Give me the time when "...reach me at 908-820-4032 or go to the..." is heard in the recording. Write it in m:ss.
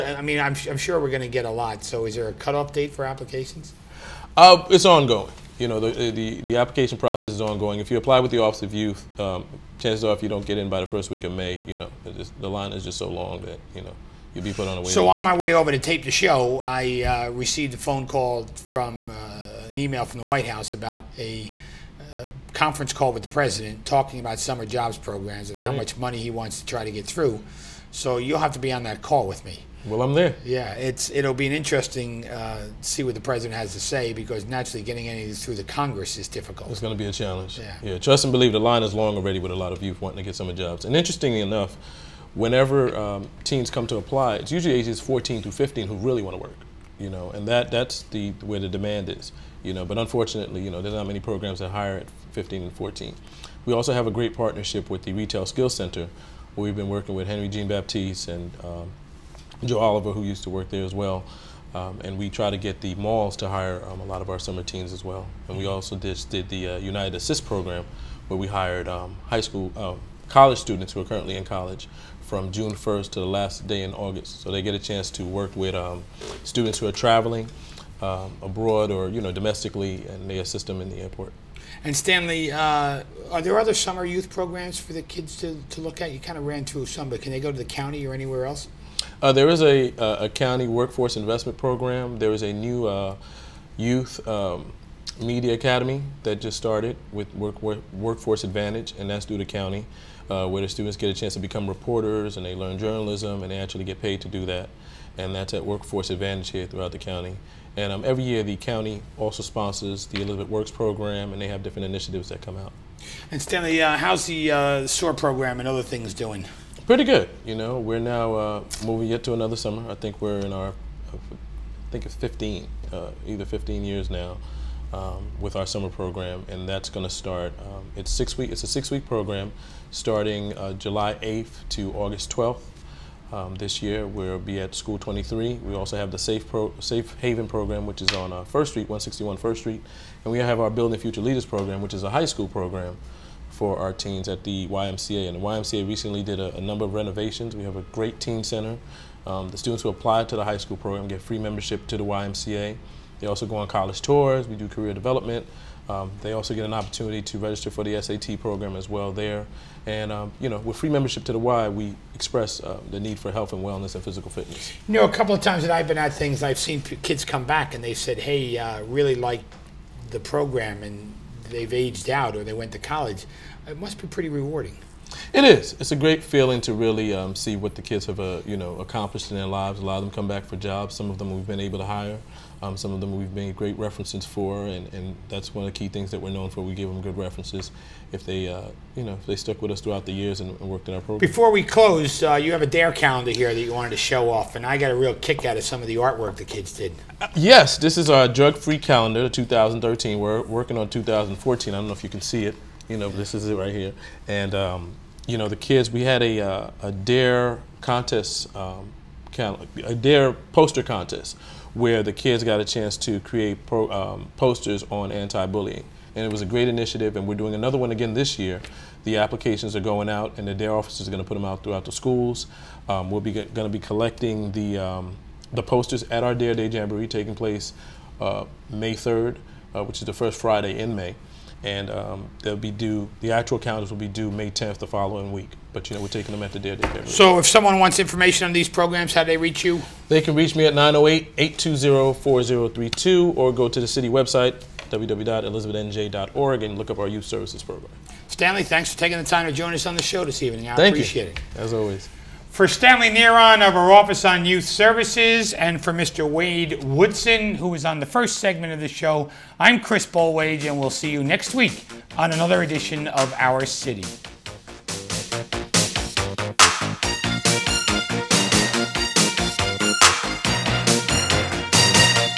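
4:00.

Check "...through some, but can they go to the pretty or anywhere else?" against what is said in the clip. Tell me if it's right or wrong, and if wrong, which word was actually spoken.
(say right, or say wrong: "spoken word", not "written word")
wrong: "county", not "pretty".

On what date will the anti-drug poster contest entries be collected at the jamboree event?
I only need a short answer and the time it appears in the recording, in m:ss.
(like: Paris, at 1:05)
May 3, at 3:48.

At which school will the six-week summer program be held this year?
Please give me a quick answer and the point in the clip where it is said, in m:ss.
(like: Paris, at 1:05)
School 23, at 2:14.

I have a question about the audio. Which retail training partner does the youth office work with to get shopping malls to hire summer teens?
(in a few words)
Retail Skills Center.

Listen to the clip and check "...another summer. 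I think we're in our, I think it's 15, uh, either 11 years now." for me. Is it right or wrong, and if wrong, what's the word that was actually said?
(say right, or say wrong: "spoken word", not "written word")
wrong: "15", not "11".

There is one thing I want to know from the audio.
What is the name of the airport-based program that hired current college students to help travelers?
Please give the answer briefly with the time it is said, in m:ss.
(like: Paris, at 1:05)
United Assist, at 1:06.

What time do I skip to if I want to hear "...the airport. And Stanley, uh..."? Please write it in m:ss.
1:20.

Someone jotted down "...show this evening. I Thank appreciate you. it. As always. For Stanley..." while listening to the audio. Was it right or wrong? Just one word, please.
right.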